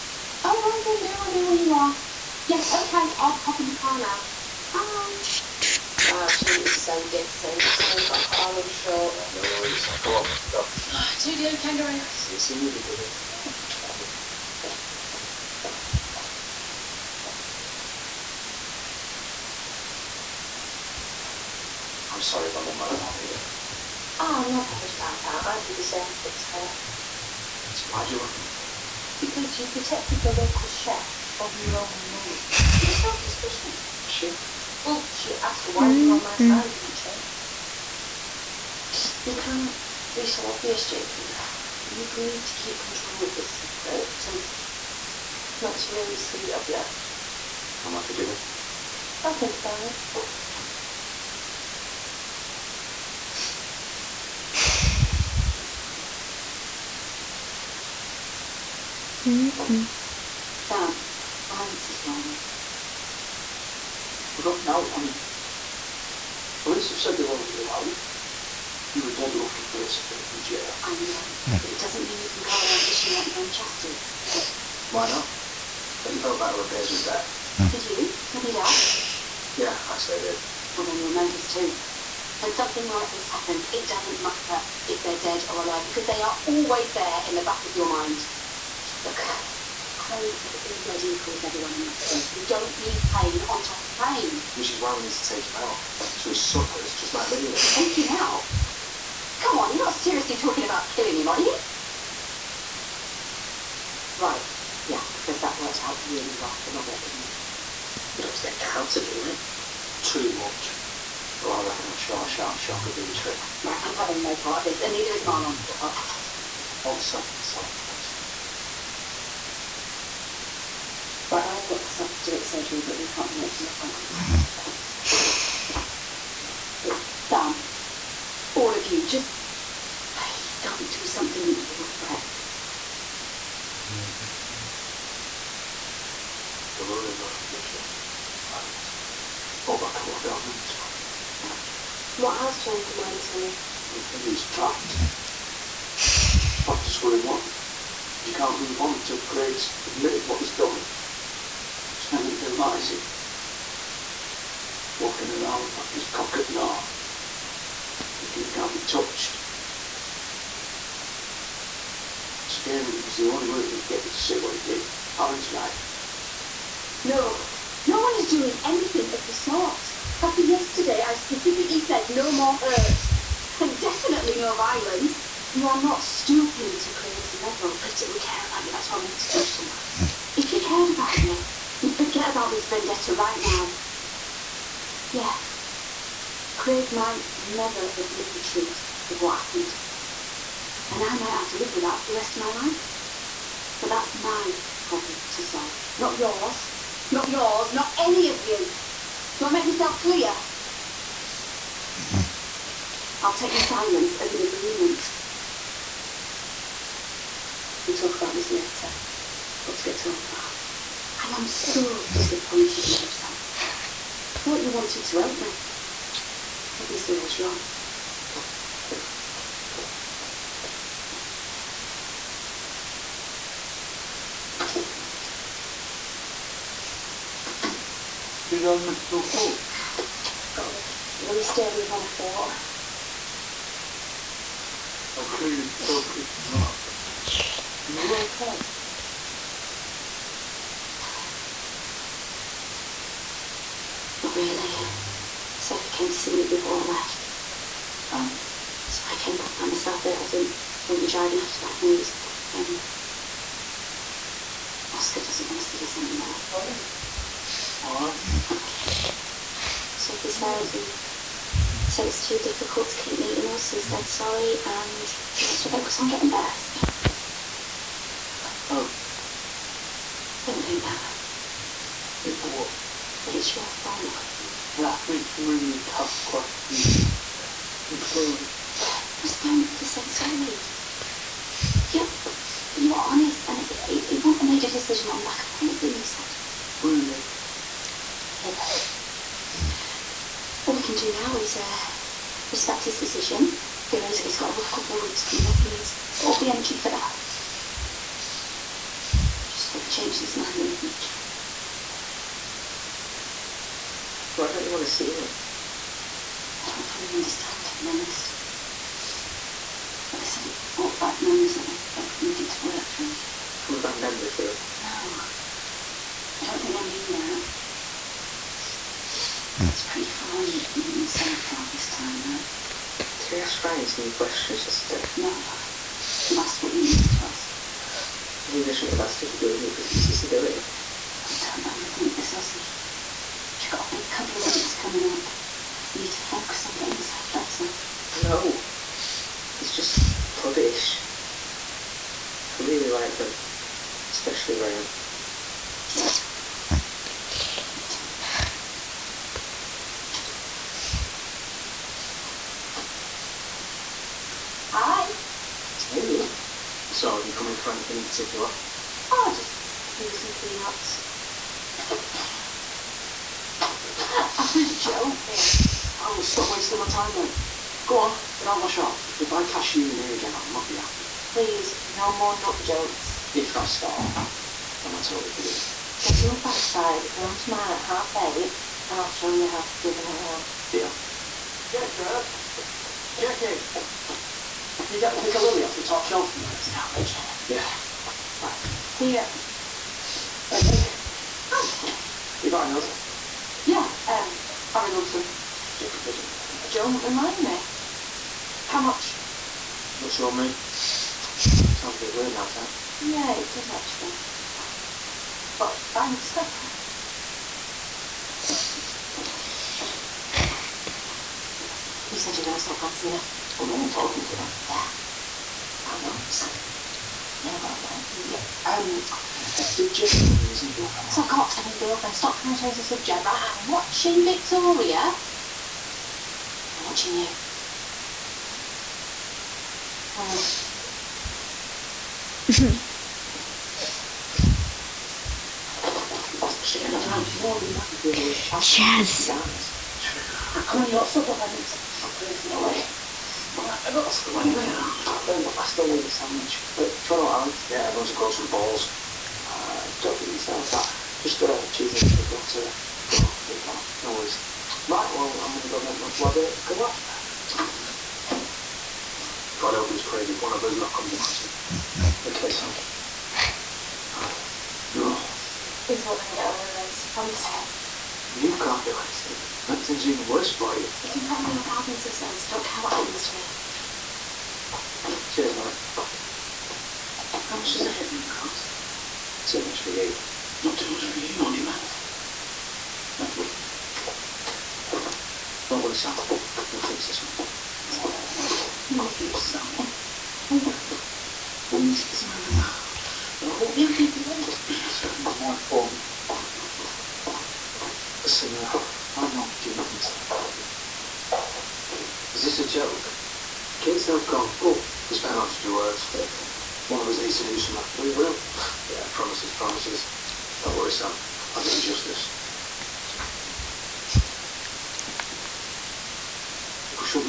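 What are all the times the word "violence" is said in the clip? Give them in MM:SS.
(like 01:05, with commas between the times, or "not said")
01:01, 02:54.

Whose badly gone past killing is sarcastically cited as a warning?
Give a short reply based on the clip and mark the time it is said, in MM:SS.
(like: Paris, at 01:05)
Robert, at 01:46.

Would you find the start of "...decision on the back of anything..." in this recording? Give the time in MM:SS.
04:44.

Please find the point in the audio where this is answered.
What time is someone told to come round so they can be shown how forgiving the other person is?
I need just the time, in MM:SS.
06:17.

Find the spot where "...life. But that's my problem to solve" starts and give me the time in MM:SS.
03:12.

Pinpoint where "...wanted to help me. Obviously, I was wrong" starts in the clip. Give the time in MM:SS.
03:34.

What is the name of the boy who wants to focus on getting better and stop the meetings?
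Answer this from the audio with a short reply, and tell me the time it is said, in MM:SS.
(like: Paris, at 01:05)
Oscar, at 04:14.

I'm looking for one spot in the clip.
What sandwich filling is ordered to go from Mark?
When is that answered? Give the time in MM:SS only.
07:31.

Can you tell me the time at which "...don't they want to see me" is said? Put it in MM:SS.
05:04.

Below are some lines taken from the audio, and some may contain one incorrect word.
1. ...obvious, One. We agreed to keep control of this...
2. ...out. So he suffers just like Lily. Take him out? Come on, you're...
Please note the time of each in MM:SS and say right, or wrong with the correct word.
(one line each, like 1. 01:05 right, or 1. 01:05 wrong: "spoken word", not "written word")
1. 00:40 wrong: "Jacob", not "One"
2. 01:35 right.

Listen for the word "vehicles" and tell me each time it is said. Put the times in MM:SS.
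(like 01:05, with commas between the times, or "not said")
not said.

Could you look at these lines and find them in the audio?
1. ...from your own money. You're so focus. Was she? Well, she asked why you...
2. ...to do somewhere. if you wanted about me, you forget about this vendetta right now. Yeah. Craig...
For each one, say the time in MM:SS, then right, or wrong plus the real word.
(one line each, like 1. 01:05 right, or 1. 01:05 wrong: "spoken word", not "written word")
1. 00:31 wrong: "suspicious", not "focus"
2. 02:59 wrong: "cared", not "wanted".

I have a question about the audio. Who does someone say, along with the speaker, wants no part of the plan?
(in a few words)
Marlon.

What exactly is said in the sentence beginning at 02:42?
Scaring him was the only way we are getting to see what he did.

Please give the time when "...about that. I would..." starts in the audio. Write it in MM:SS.
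00:24.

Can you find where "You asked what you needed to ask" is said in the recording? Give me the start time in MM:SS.
05:26.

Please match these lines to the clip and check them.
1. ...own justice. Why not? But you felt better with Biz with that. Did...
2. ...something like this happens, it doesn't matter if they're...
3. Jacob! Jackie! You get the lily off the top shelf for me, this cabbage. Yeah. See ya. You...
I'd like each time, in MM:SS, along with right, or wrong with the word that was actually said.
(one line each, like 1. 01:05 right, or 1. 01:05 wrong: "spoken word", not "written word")
1. 01:13 right
2. 01:22 right
3. 06:21 right.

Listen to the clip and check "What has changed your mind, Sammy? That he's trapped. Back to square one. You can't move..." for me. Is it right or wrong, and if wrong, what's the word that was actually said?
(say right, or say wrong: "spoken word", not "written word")
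right.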